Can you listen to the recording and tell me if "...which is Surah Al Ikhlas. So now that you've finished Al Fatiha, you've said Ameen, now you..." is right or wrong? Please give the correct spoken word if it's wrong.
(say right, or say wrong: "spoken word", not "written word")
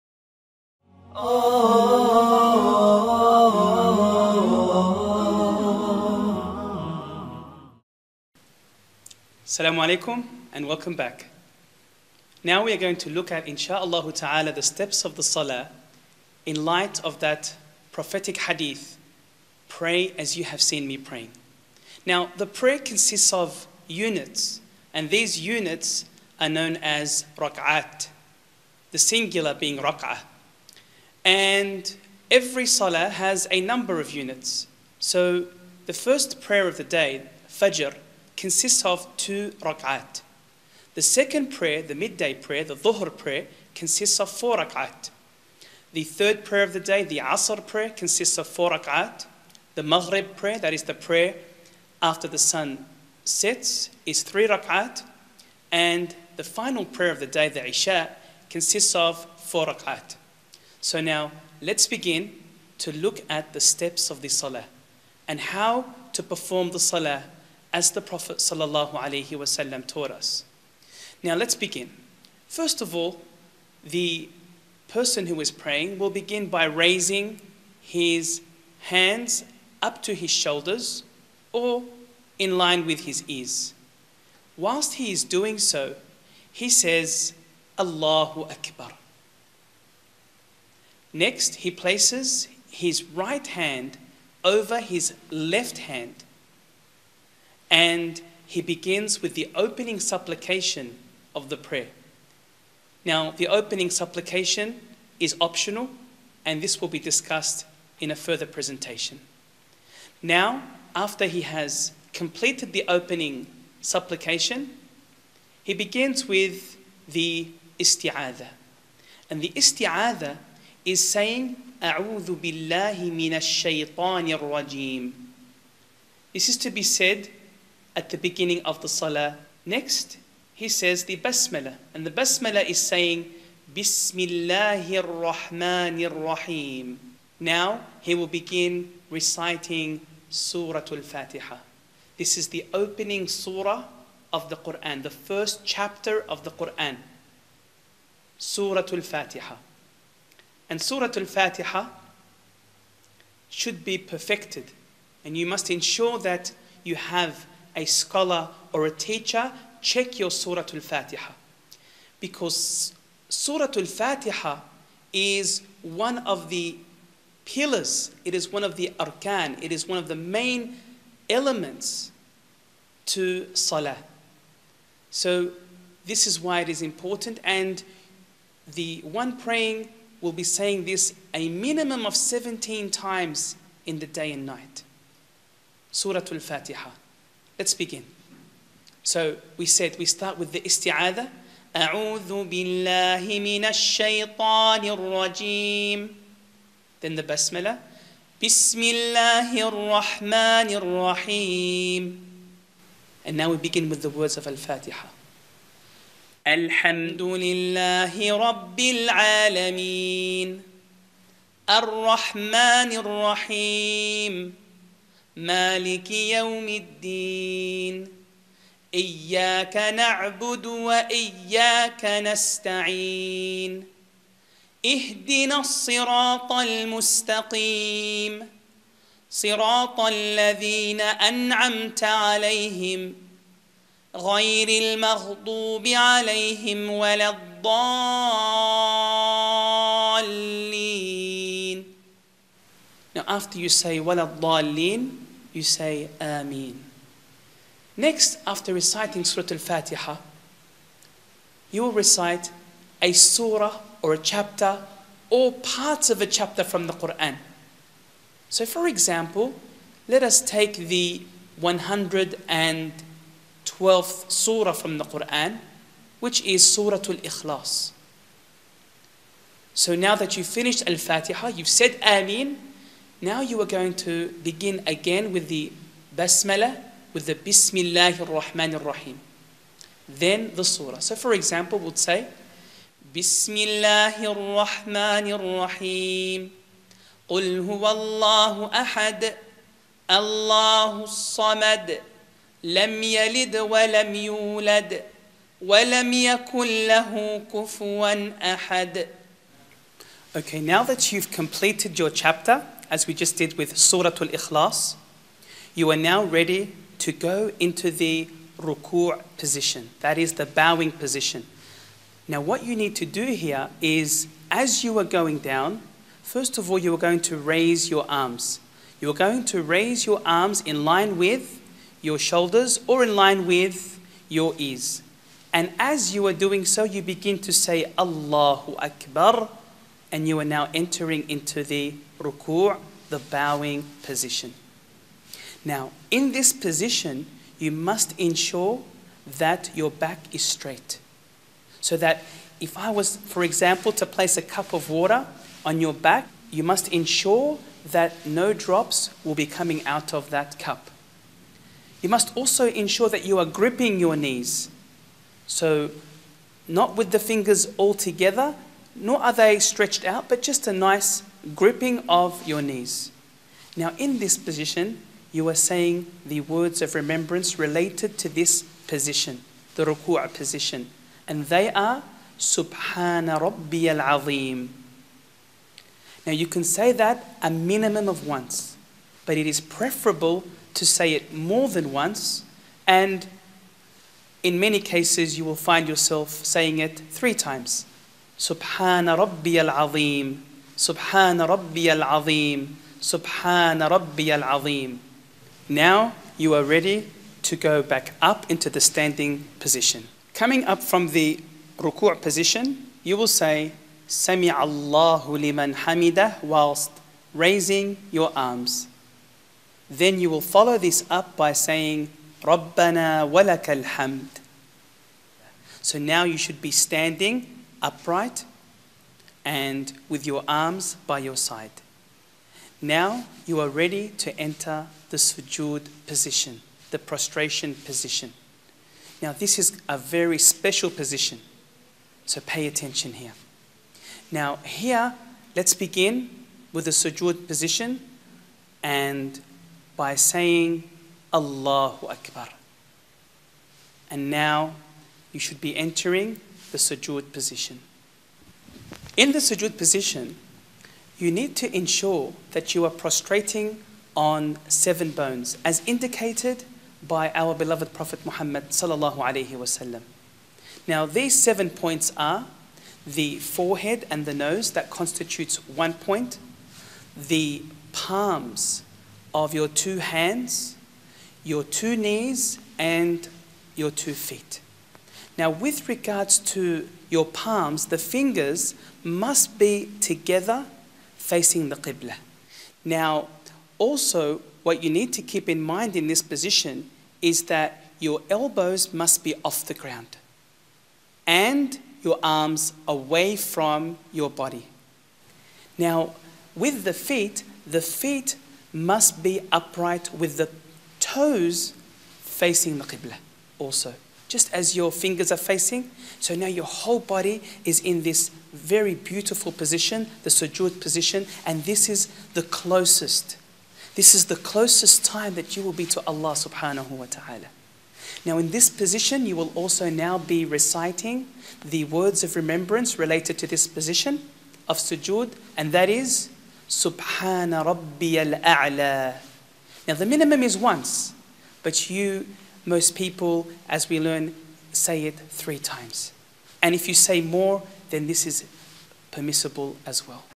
right.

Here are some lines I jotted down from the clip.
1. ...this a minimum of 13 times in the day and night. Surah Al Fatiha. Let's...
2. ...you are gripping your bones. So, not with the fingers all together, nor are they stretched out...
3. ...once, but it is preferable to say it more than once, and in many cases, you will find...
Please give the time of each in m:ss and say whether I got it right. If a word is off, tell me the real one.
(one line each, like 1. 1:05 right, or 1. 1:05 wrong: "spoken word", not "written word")
1. 3:00 wrong: "17", not "13"
2. 5:53 wrong: "knees", not "bones"
3. 6:18 right.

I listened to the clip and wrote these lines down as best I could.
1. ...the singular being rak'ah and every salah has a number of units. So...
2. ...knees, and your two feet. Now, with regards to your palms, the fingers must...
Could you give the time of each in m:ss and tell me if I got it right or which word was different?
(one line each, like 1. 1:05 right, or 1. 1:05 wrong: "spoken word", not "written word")
1. 0:28 right
2. 7:51 right.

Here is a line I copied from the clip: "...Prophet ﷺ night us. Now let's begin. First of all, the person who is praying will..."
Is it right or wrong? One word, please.
wrong.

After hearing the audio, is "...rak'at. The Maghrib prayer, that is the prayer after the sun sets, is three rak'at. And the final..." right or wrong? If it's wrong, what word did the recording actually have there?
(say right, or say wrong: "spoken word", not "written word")
right.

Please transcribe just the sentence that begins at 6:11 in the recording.
And they are Subhana Rabbi al Azim.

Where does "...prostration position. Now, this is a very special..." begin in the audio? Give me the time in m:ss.
7:06.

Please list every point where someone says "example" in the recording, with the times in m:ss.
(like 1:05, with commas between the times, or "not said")
4:18, 4:41, 5:43.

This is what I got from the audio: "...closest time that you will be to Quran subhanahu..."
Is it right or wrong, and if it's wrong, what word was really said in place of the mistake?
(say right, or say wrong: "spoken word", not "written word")
wrong: "Allah", not "Quran".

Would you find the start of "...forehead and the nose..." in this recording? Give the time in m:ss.
7:43.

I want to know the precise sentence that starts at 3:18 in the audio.
بسم الله الرحمن rahim And now we begin with the words of Al Fatiha.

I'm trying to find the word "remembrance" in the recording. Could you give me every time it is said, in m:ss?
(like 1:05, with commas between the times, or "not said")
6:06, 8:42.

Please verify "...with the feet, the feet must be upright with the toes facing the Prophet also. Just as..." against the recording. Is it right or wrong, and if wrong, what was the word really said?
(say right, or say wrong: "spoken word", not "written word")
wrong: "Qibla", not "Prophet".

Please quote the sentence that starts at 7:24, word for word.
And now you should be entering the sujood position.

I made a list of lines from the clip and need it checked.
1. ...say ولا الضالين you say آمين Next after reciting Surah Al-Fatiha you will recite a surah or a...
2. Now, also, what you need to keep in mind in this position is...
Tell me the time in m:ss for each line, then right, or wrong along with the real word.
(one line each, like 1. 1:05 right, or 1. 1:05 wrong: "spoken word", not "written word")
1. 4:03 right
2. 8:02 right.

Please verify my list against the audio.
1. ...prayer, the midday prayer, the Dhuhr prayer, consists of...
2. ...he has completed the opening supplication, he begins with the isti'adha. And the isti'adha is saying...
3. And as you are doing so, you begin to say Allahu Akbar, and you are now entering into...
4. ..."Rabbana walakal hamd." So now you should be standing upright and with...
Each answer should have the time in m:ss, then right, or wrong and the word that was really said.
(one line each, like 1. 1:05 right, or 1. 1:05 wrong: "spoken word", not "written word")
1. 0:41 right
2. 1:51 right
3. 5:25 right
4. 6:52 right.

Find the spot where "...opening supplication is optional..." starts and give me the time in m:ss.
1:43.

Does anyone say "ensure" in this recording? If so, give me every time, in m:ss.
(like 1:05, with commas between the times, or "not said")
2:35, 5:38, 5:46, 5:52, 7:31.